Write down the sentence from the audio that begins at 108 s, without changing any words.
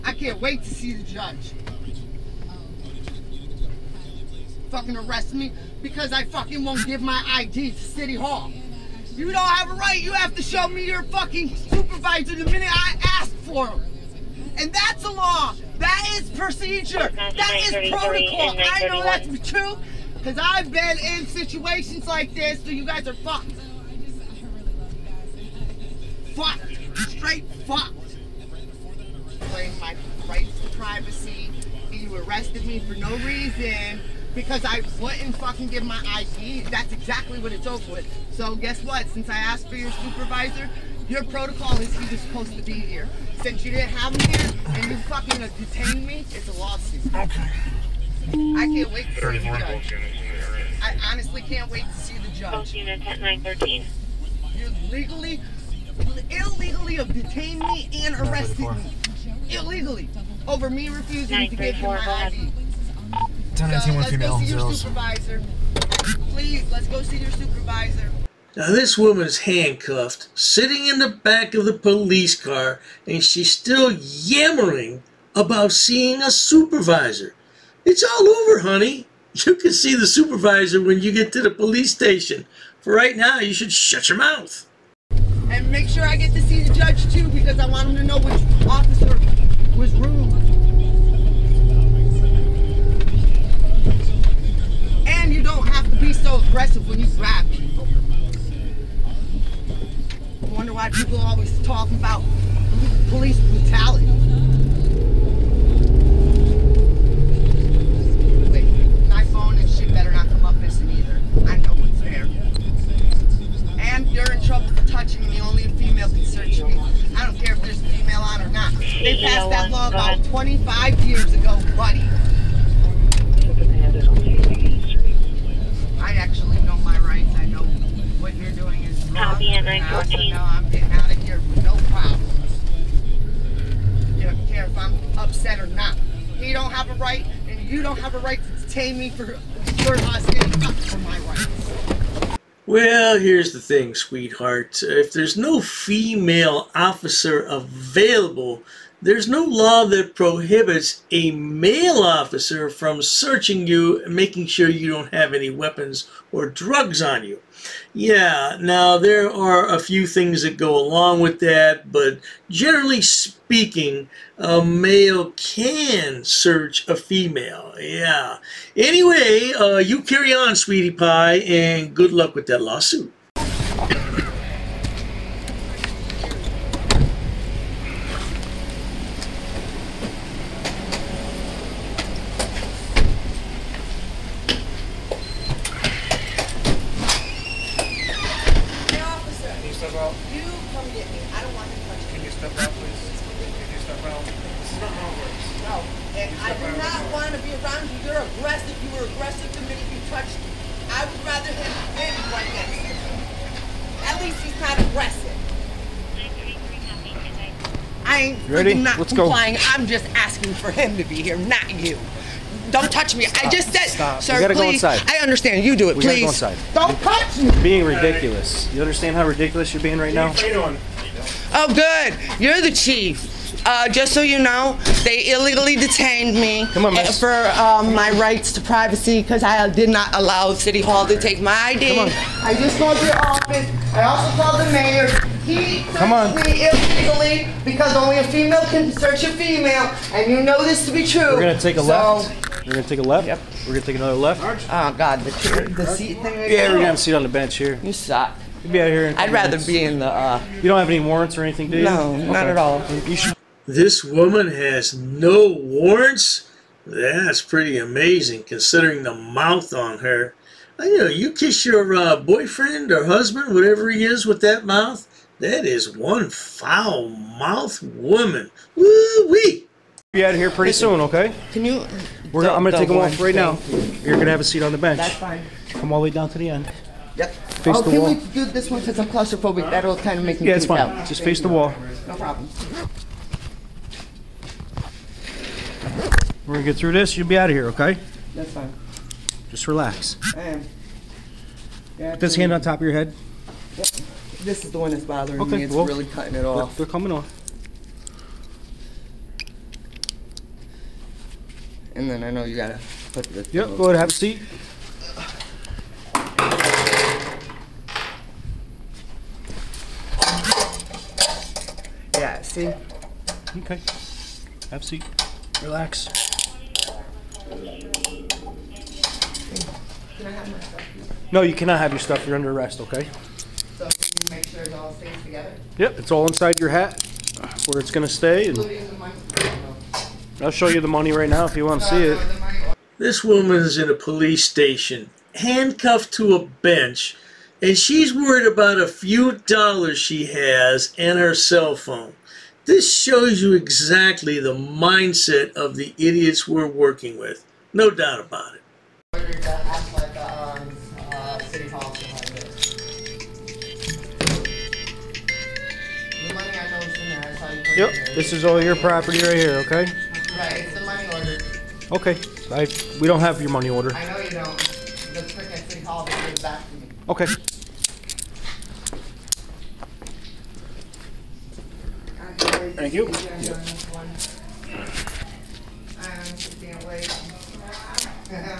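Wait, my phone and shit better not come up missing either.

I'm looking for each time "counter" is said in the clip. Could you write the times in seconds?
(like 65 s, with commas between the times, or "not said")
not said.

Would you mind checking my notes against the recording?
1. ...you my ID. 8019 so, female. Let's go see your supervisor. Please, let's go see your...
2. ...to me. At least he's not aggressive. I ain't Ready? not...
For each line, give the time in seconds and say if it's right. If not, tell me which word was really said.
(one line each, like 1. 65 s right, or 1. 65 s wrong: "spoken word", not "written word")
1. 61 s wrong: "1019", not "8019"
2. 202 s right.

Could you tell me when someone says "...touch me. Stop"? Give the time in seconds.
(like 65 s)
212 s.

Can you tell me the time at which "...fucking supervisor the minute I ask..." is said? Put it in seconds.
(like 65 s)
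11 s.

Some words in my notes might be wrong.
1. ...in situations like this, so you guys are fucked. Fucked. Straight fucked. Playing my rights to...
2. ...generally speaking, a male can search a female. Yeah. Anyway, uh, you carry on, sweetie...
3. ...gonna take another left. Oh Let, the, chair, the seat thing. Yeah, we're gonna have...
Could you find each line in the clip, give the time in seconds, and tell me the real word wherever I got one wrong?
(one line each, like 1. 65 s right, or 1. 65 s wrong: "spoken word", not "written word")
1. 20 s right
2. 162 s right
3. 243 s wrong: "God", not "Let".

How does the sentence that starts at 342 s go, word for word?
This shows you exactly the mindset of the idiots we're working with.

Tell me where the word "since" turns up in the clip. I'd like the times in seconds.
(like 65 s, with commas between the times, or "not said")
39 s, 43 s, 278 s.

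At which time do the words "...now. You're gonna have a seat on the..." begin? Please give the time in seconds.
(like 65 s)
273 s.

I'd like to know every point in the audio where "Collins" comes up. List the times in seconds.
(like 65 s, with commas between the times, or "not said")
not said.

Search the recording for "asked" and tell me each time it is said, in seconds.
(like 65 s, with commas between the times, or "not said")
39 s.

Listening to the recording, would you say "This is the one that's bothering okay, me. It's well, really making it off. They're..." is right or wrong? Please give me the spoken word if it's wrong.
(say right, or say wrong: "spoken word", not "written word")
wrong: "cutting", not "making".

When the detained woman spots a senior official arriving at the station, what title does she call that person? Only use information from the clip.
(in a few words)
the chief.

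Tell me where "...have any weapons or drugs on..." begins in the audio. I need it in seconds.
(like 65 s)
155 s.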